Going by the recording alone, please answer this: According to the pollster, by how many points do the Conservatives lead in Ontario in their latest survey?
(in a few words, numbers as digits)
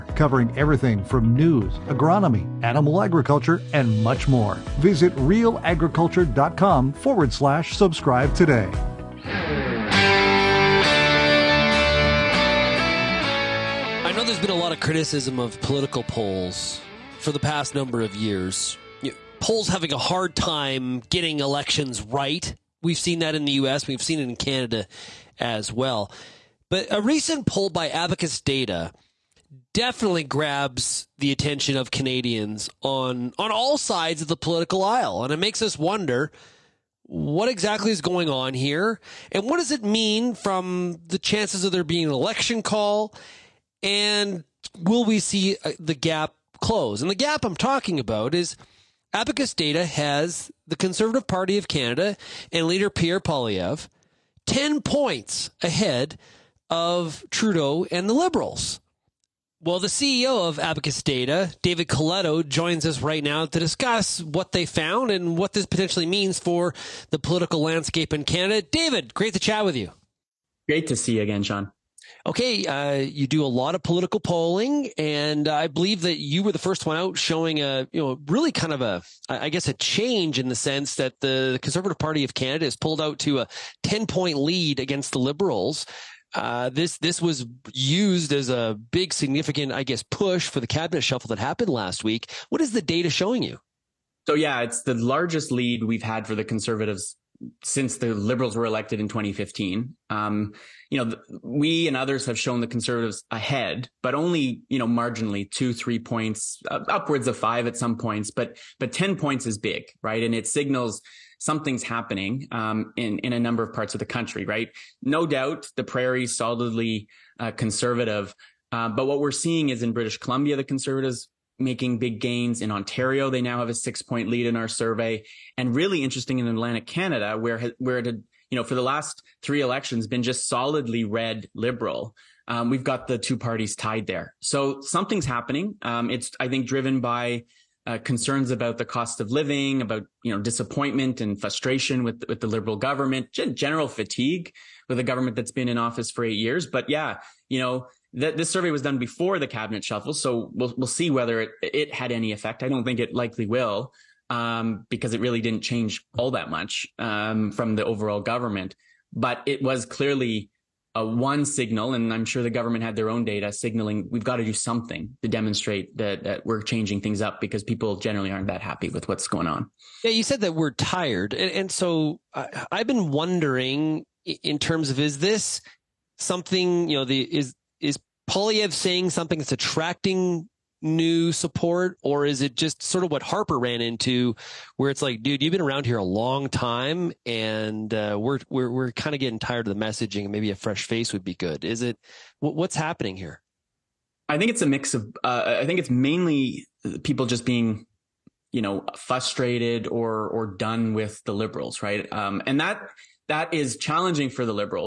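6.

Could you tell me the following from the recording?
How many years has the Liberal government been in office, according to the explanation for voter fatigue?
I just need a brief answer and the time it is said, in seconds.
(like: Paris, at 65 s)
8, at 146 s.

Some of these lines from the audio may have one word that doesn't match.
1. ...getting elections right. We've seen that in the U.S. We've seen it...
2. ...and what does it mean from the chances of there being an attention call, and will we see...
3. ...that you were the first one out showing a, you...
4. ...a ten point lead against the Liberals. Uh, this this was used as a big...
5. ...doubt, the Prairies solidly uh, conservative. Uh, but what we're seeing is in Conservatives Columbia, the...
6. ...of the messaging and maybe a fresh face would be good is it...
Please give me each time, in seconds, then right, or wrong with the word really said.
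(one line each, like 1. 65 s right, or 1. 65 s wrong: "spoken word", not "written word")
1. 21 s right
2. 39 s wrong: "election", not "attention"
3. 76 s right
4. 83 s right
5. 115 s wrong: "British", not "Conservatives"
6. 189 s right.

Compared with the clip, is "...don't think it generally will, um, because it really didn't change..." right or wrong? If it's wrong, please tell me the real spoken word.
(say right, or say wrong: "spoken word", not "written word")
wrong: "likely", not "generally".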